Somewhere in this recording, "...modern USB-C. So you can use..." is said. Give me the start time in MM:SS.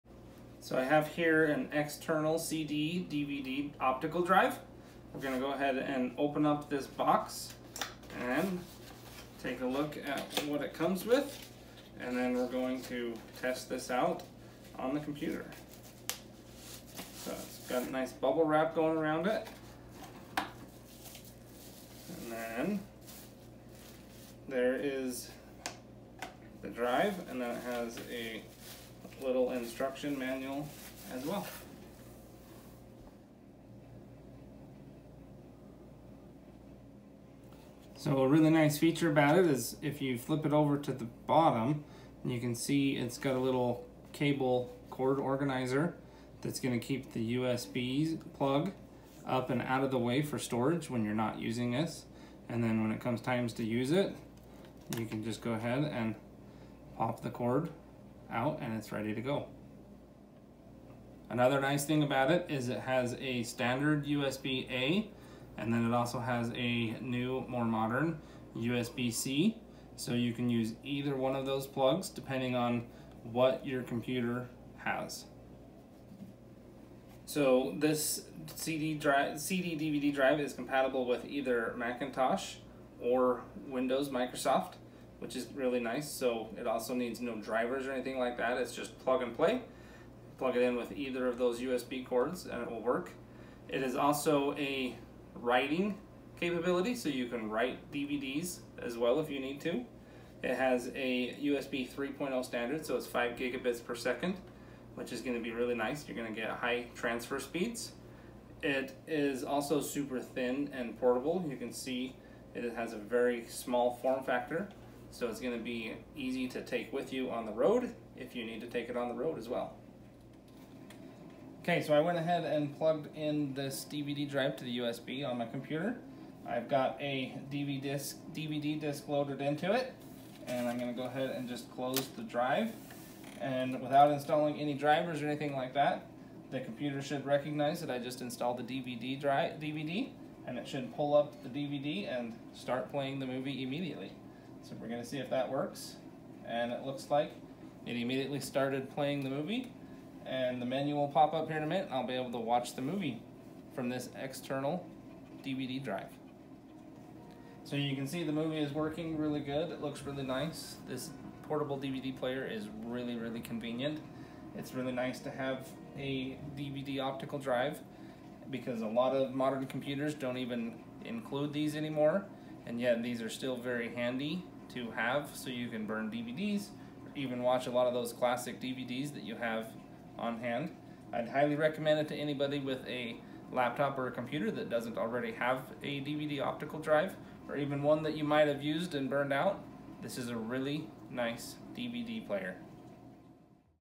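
01:07.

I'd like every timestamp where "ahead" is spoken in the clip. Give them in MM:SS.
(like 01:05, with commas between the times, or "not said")
00:05, 00:55, 02:02, 02:11.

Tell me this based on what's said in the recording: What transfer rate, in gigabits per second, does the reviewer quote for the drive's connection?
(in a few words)
5 gigabits per second.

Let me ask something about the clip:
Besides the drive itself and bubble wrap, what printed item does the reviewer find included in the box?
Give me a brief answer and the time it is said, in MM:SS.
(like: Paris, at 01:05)
instruction manual, at 00:29.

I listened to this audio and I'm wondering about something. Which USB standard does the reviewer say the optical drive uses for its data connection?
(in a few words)
USB 3.0.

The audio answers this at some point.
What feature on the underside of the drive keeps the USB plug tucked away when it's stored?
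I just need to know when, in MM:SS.
00:44.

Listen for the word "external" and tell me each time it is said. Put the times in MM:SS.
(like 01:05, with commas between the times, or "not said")
00:01, 02:34.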